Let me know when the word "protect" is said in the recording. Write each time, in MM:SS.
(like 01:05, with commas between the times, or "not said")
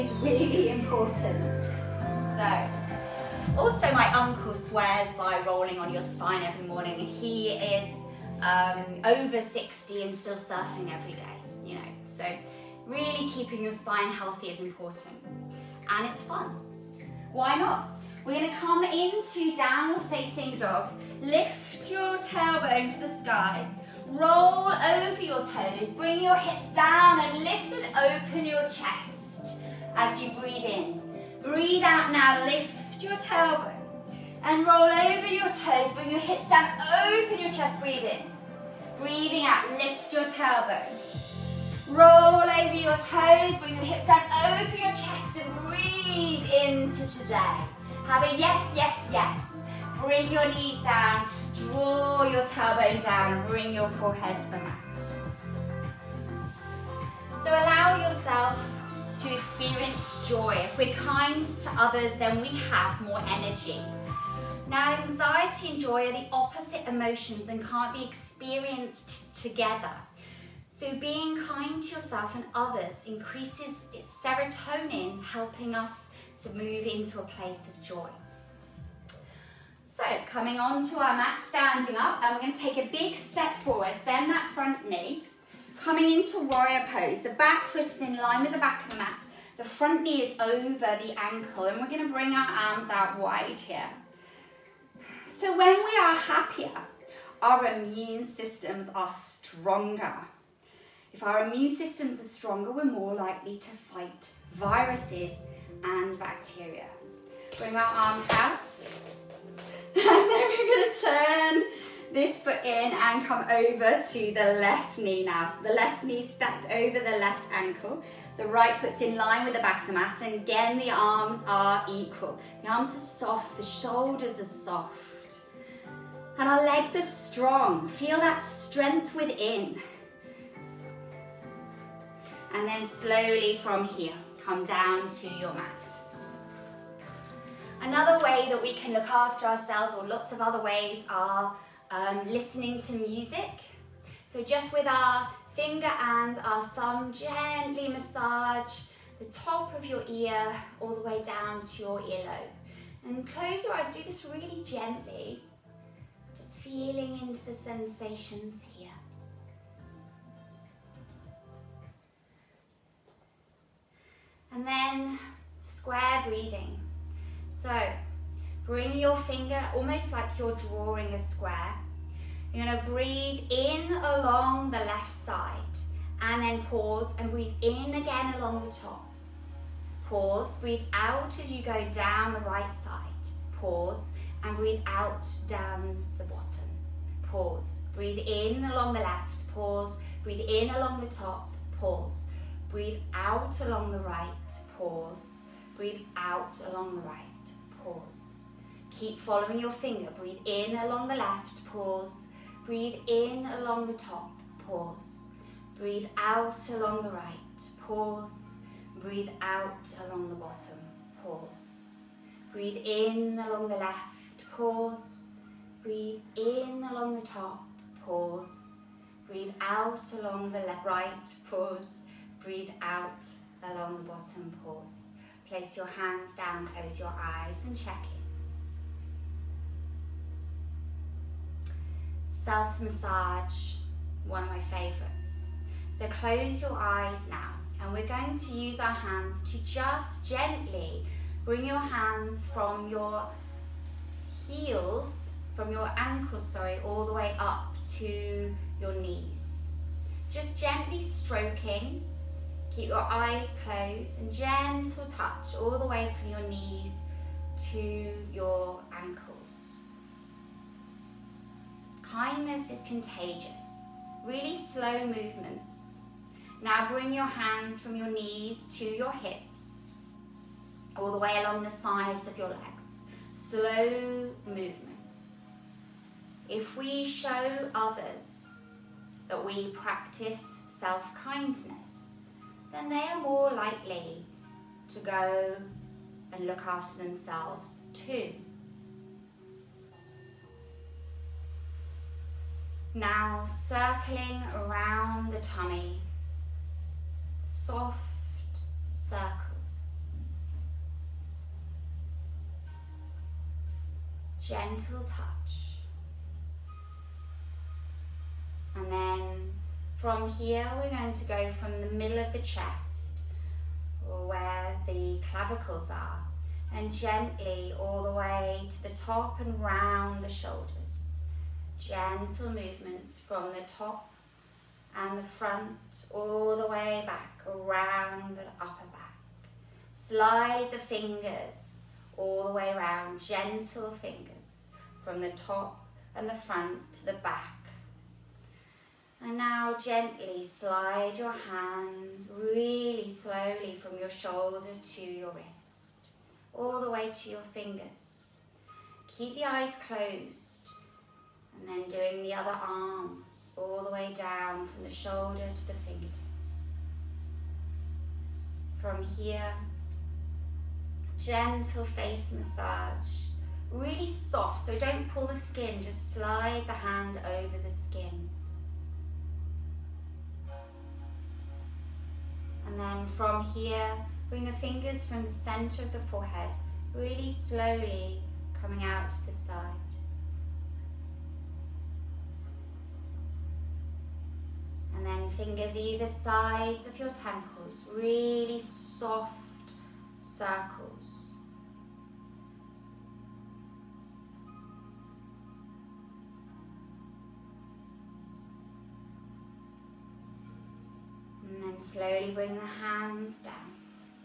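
not said.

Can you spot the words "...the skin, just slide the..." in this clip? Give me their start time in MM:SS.
06:05.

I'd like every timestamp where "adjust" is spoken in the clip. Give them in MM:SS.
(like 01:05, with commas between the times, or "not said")
not said.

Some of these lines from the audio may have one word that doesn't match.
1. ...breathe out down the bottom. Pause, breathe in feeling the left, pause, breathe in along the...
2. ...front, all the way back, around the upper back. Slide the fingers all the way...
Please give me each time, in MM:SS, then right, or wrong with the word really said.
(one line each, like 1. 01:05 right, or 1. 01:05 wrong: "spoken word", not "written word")
1. 03:04 wrong: "along", not "feeling"
2. 05:25 right.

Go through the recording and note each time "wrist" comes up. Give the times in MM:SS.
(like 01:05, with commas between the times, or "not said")
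05:45.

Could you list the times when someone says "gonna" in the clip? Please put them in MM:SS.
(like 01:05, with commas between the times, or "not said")
00:18, 01:50, 02:52.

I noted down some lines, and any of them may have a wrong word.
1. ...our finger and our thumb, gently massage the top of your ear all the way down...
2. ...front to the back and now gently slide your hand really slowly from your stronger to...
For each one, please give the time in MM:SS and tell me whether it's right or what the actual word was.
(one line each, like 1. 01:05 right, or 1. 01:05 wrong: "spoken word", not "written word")
1. 02:24 right
2. 05:36 wrong: "shoulder", not "stronger".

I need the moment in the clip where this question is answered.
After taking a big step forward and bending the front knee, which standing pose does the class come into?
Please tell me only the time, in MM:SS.
01:26.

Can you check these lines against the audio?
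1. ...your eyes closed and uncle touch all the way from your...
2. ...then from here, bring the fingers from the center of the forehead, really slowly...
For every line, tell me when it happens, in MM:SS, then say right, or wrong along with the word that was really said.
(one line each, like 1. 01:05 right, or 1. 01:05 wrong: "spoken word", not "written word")
1. 04:12 wrong: "gentle", not "uncle"
2. 06:12 right.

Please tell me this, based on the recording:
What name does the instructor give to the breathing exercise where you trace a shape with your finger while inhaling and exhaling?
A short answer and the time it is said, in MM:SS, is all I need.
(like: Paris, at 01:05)
Square breathing, at 02:45.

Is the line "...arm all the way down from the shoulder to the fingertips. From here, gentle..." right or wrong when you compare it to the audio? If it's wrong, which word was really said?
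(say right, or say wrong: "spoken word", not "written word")
right.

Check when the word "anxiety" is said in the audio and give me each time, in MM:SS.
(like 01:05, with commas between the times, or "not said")
01:05.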